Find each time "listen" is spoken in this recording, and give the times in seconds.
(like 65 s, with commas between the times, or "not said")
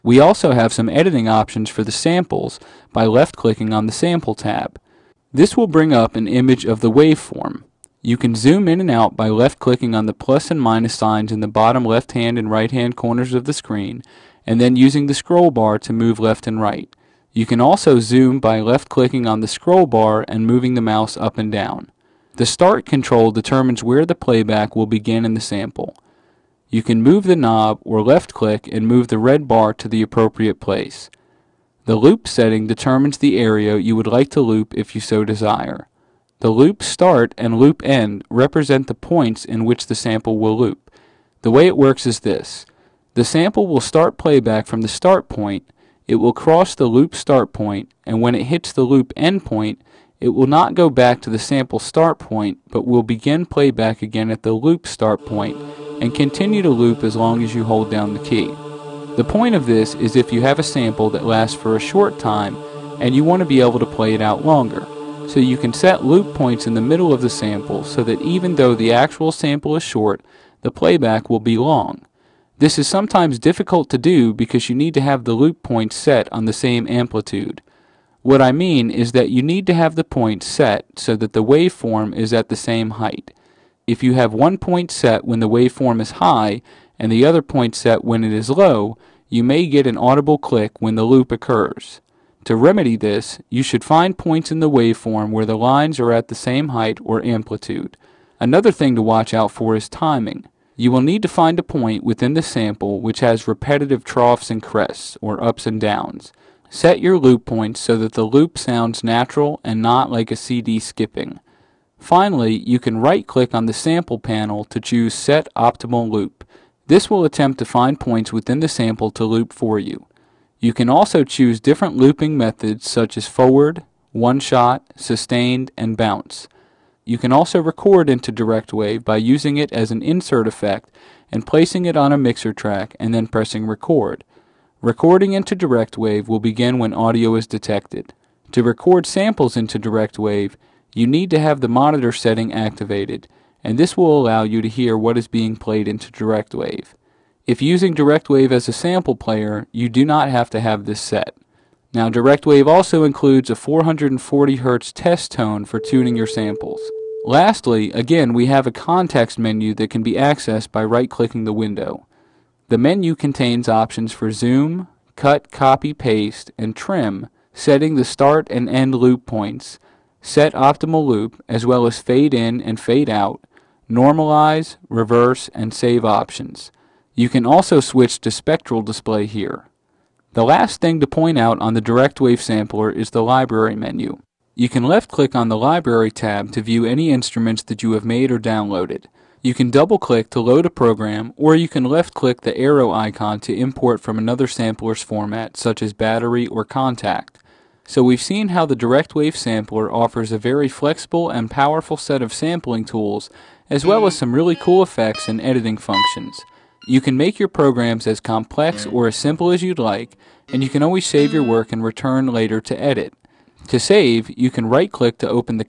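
not said.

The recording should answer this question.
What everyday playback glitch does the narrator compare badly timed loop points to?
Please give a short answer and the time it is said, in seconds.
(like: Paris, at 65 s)
A CD skipping, at 110 s.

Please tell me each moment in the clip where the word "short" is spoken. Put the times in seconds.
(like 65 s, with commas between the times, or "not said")
61 s, 69 s.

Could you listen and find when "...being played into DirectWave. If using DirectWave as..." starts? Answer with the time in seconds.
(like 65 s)
145 s.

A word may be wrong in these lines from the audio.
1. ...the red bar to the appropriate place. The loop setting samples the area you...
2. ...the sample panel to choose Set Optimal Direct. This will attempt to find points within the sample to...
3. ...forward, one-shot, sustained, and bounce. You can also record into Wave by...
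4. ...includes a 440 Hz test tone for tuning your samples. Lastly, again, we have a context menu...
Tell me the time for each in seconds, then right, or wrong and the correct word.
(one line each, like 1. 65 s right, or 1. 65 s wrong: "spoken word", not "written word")
1. 29 s wrong: "determines", not "samples"
2. 113 s wrong: "Loop", not "Direct"
3. 123 s wrong: "DirectWave", not "Wave"
4. 153 s right.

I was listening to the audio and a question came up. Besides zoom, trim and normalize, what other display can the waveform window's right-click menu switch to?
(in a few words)
Spectral display.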